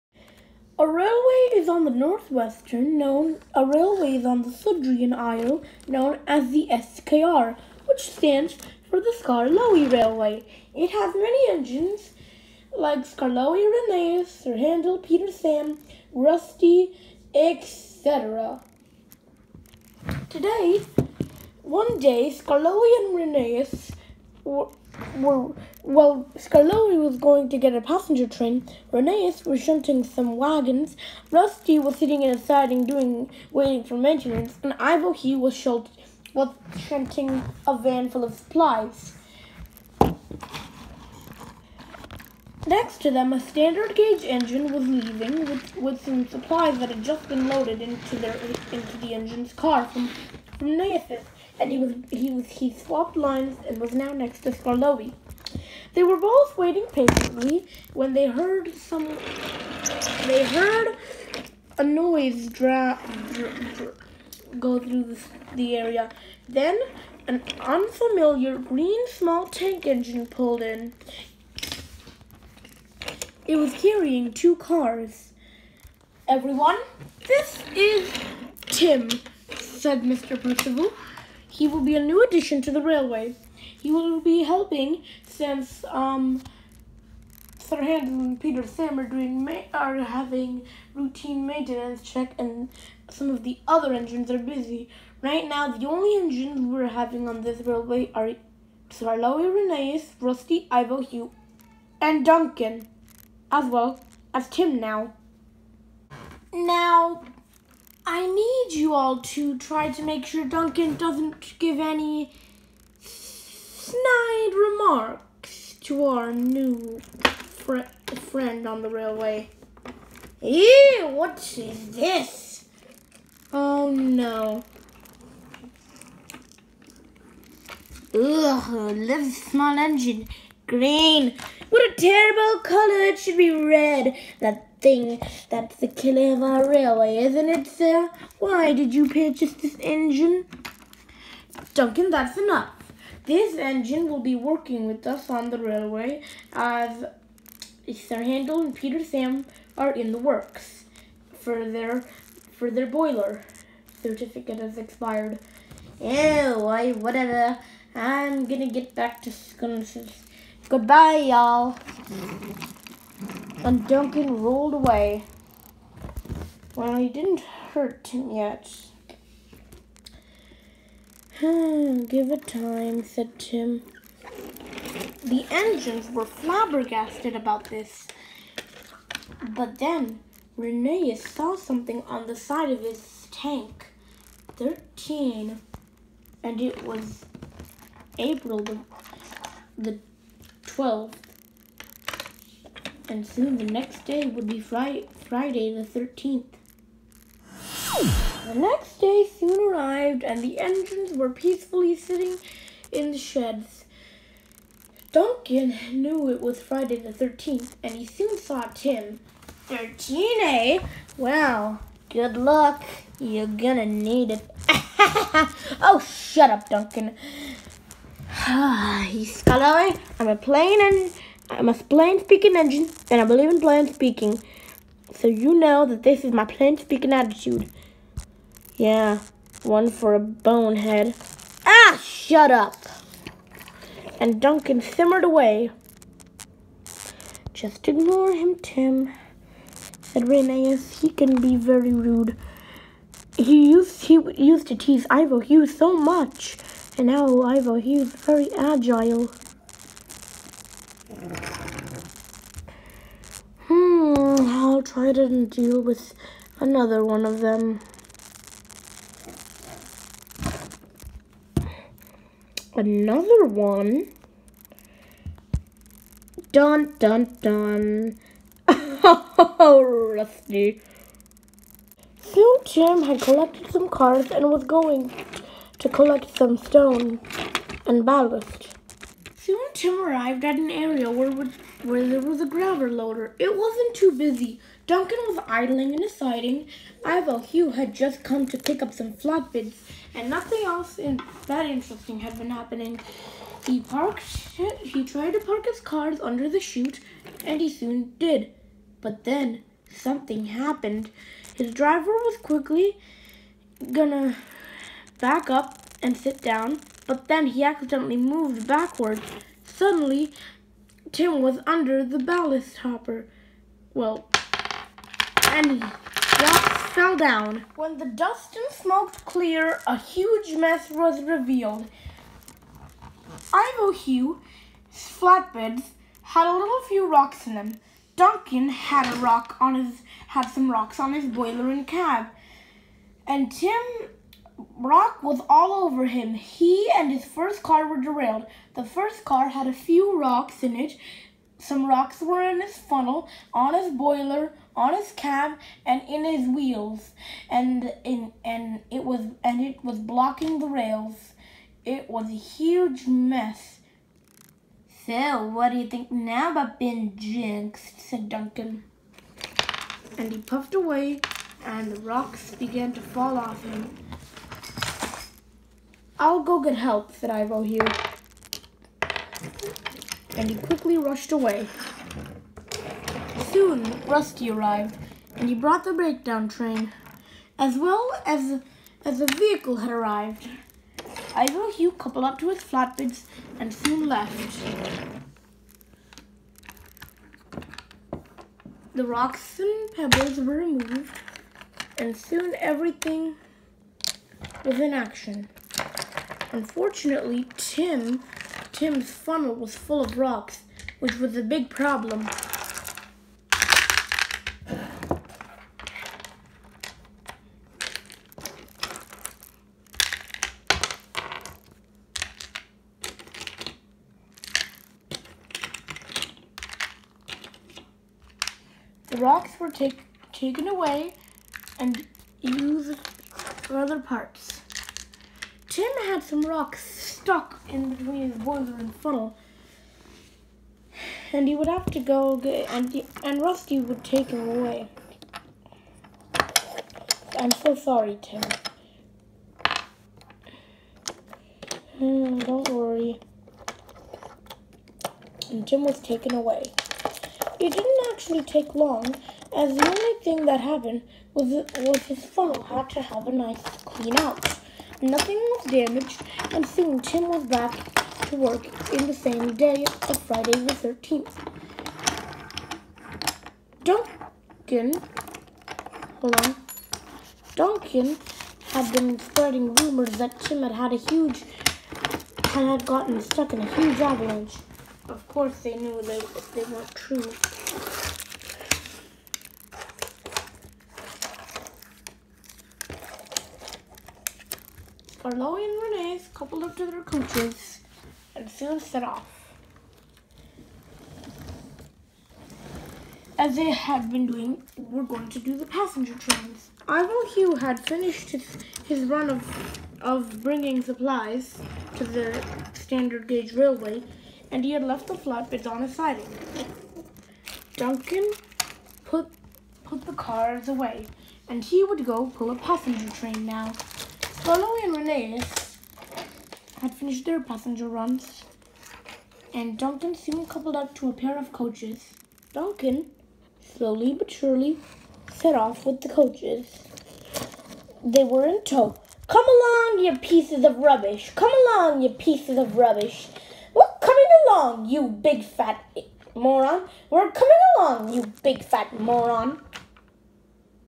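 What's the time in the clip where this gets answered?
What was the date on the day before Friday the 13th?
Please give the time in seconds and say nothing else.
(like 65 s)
188 s.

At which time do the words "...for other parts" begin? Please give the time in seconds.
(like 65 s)
423 s.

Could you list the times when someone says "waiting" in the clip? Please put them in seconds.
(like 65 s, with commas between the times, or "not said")
33 s, 56 s.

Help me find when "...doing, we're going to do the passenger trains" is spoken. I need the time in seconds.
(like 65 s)
494 s.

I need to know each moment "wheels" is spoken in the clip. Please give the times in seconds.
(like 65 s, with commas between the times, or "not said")
346 s.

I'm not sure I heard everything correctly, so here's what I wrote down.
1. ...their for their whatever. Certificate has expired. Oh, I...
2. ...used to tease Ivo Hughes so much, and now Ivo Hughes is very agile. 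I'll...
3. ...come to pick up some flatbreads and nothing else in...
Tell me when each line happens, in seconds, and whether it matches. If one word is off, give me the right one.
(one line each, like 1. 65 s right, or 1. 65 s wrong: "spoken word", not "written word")
1. 151 s wrong: "boiler", not "whatever"
2. 244 s right
3. 288 s right.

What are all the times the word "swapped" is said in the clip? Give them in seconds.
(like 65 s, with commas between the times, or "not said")
52 s.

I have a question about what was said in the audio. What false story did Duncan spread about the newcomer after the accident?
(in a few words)
Huge avalanche.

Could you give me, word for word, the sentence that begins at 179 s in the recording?
But then, Renee saw something on the side of his tank.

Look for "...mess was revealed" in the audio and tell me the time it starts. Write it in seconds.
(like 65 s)
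320 s.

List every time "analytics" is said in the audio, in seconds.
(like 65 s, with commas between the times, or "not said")
not said.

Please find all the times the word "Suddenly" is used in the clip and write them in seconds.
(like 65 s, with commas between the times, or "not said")
309 s.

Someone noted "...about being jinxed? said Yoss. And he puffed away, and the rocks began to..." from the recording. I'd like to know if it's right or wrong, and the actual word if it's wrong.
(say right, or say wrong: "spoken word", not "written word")
wrong: "Duncan", not "Yoss".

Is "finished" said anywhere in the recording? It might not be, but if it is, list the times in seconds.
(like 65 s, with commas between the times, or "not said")
497 s, 516 s.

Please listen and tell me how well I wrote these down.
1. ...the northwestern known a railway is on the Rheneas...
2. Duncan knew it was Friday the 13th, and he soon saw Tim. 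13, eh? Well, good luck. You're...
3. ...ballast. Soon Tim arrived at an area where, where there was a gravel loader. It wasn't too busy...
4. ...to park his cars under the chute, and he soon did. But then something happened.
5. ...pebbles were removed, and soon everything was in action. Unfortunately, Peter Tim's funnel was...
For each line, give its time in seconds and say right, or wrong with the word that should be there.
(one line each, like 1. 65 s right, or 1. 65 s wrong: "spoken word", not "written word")
1. 1 s wrong: "Sudrian", not "Rheneas"
2. 205 s right
3. 278 s right
4. 295 s right
5. 390 s wrong: "Tim", not "Peter".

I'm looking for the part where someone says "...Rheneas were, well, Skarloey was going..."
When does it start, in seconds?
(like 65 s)
23 s.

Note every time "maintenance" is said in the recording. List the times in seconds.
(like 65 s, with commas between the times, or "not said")
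33 s, 91 s.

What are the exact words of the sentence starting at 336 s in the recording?
He and his first car were derailed.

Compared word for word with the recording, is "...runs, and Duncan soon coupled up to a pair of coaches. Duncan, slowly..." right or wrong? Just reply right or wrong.
right.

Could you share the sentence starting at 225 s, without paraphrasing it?
So you know that this is my plain speaking attitude.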